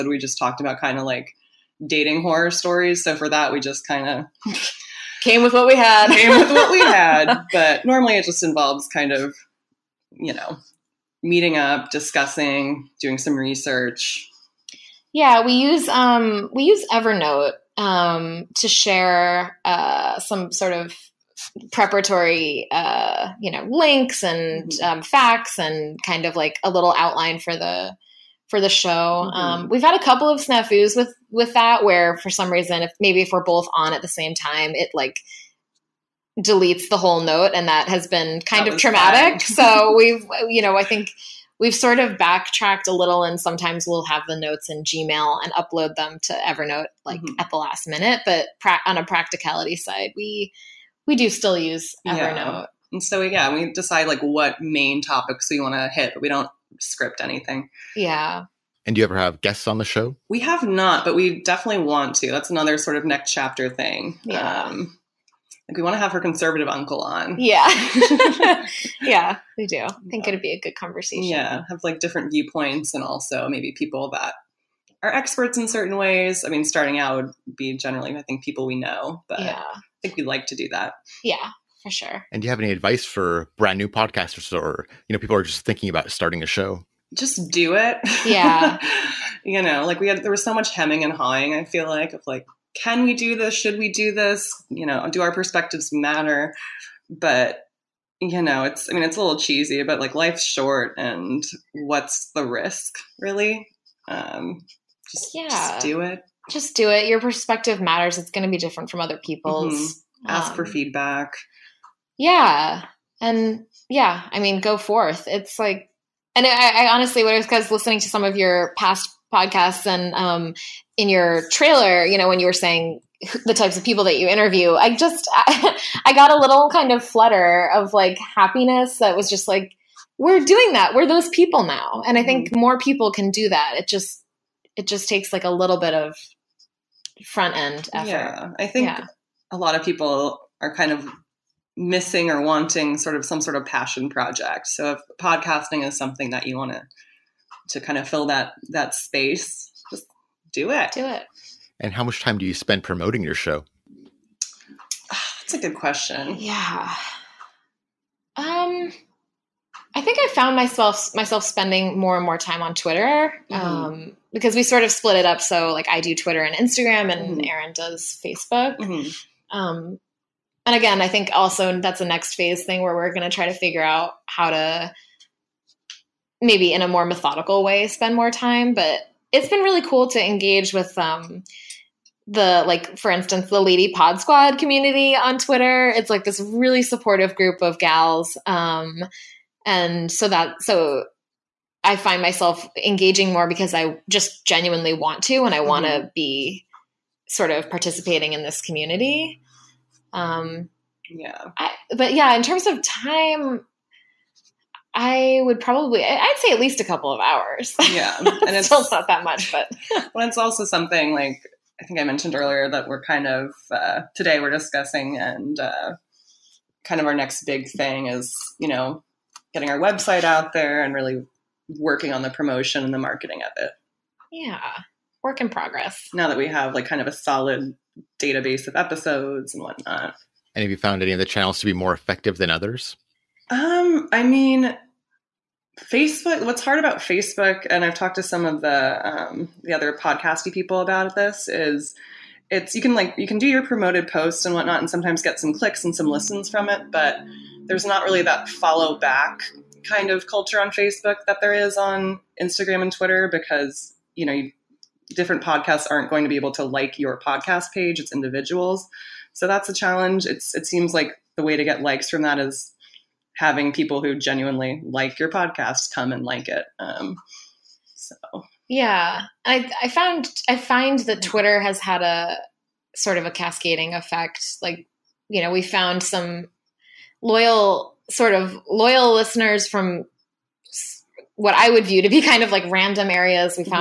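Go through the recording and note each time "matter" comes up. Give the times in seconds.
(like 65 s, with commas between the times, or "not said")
95 s, 107 s.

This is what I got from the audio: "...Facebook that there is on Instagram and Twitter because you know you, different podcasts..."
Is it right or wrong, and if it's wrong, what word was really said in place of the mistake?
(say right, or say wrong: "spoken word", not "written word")
right.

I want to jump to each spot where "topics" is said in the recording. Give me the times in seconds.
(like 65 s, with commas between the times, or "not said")
55 s.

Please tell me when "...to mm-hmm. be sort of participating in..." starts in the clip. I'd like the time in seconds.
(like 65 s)
195 s.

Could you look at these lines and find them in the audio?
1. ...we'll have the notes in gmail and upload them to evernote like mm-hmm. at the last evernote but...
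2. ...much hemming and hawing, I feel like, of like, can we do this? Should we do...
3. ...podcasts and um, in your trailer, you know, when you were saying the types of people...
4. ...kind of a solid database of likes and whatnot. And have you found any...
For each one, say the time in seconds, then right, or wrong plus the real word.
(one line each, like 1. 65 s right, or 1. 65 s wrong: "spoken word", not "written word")
1. 43 s wrong: "minute", not "evernote"
2. 90 s right
3. 119 s right
4. 226 s wrong: "episodes", not "likes".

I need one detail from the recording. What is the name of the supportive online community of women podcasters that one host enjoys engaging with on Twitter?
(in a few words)
Lady Pod Squad.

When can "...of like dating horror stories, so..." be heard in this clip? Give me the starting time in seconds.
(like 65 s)
0 s.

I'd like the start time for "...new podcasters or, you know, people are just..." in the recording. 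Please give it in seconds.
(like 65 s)
83 s.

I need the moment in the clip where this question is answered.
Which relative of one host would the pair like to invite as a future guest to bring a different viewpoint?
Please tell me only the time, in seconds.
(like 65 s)
66 s.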